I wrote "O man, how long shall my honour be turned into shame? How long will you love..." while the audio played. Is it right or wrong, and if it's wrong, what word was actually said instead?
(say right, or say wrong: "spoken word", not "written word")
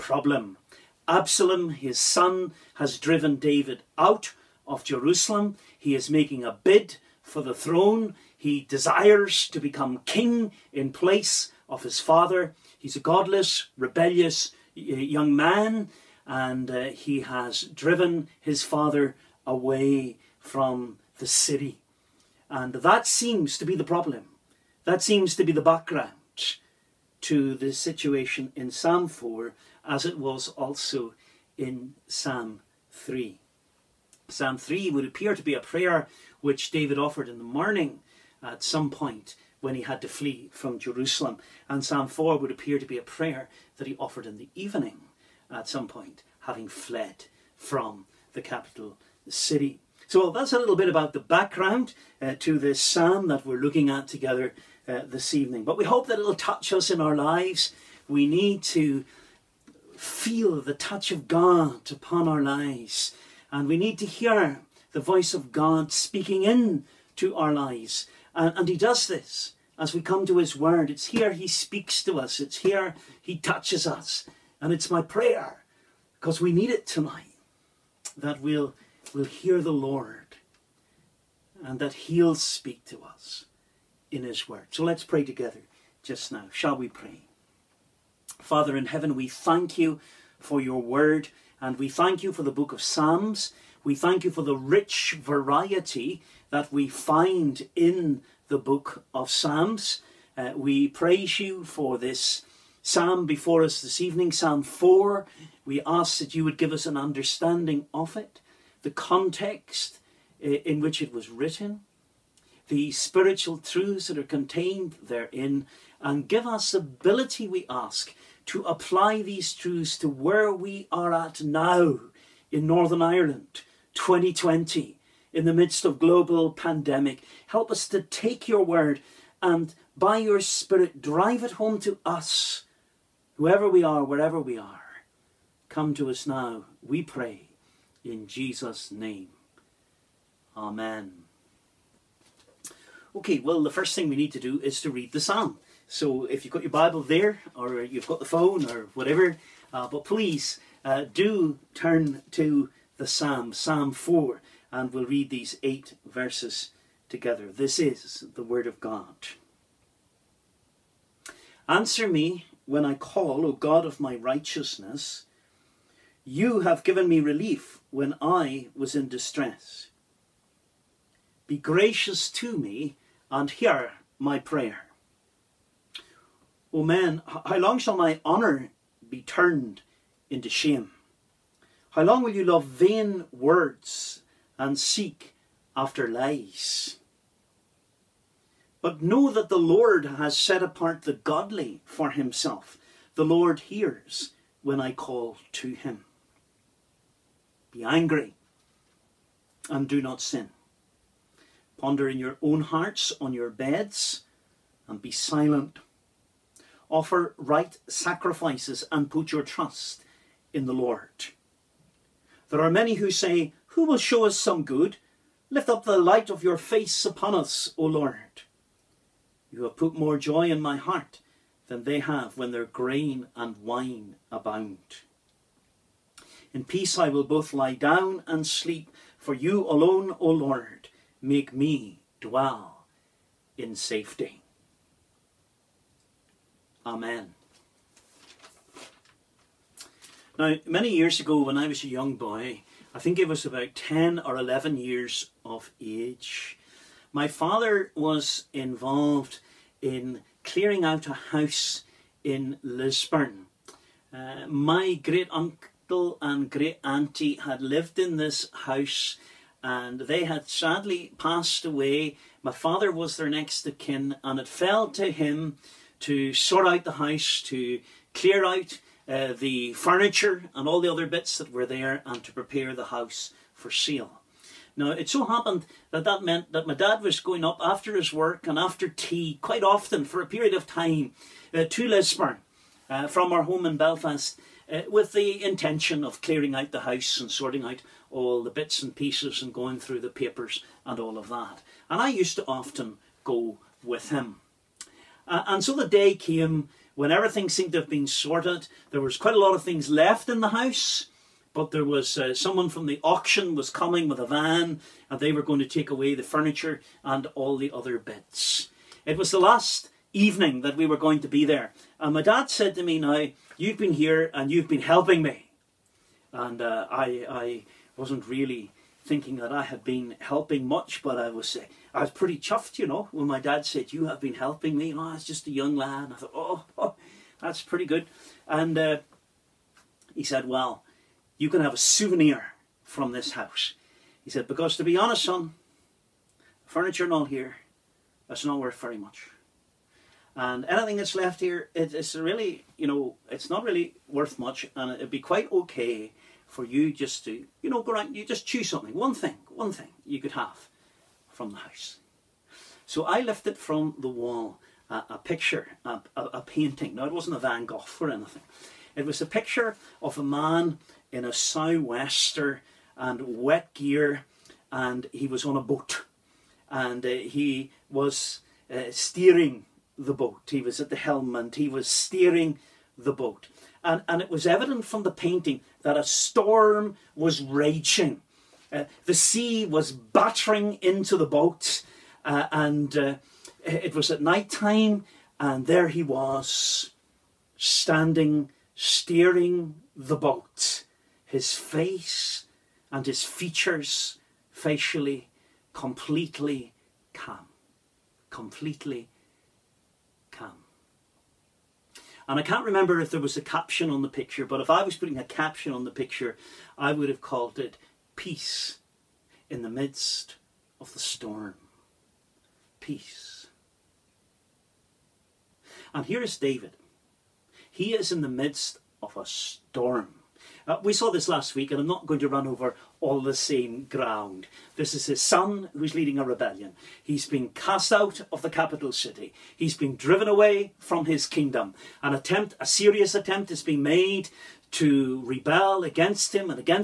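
right.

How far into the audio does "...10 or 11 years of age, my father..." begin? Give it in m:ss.
4:03.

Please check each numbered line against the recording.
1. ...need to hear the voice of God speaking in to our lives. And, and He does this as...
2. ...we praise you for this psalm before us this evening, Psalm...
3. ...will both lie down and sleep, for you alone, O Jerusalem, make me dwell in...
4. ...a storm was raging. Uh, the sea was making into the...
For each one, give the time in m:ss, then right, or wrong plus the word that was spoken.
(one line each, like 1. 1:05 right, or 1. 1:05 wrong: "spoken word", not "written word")
1. 1:03 right
2. 1:40 right
3. 3:47 wrong: "Lord", not "Jerusalem"
4. 6:15 wrong: "battering", not "making".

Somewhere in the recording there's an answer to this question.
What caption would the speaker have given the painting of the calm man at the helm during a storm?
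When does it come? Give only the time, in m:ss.
6:48.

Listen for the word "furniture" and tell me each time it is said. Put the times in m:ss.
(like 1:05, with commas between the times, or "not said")
4:29, 5:06, 5:36.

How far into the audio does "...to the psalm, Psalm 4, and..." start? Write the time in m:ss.
2:32.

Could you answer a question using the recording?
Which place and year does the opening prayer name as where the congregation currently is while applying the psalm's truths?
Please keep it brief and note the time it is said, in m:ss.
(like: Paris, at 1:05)
Northern Ireland 2020, at 2:02.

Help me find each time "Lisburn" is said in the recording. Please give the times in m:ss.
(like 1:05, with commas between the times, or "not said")
4:12, 4:41.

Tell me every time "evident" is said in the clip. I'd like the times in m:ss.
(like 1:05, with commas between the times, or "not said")
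6:14.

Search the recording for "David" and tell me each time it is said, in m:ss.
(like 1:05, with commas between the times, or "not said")
0:03, 0:36, 6:56.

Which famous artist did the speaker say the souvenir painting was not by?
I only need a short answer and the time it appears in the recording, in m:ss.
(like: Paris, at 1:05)
Van Gogh, at 5:57.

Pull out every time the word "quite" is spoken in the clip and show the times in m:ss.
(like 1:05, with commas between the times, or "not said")
4:39, 4:59, 5:45.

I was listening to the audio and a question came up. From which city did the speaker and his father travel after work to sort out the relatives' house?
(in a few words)
Belfast.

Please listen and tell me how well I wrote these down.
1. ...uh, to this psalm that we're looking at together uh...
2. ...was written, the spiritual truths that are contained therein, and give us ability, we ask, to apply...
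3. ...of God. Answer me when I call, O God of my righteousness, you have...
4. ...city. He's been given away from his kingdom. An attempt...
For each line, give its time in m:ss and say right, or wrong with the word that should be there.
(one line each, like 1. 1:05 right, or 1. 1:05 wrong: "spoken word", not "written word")
1. 0:52 right
2. 1:51 right
3. 2:38 right
4. 7:08 wrong: "driven", not "given".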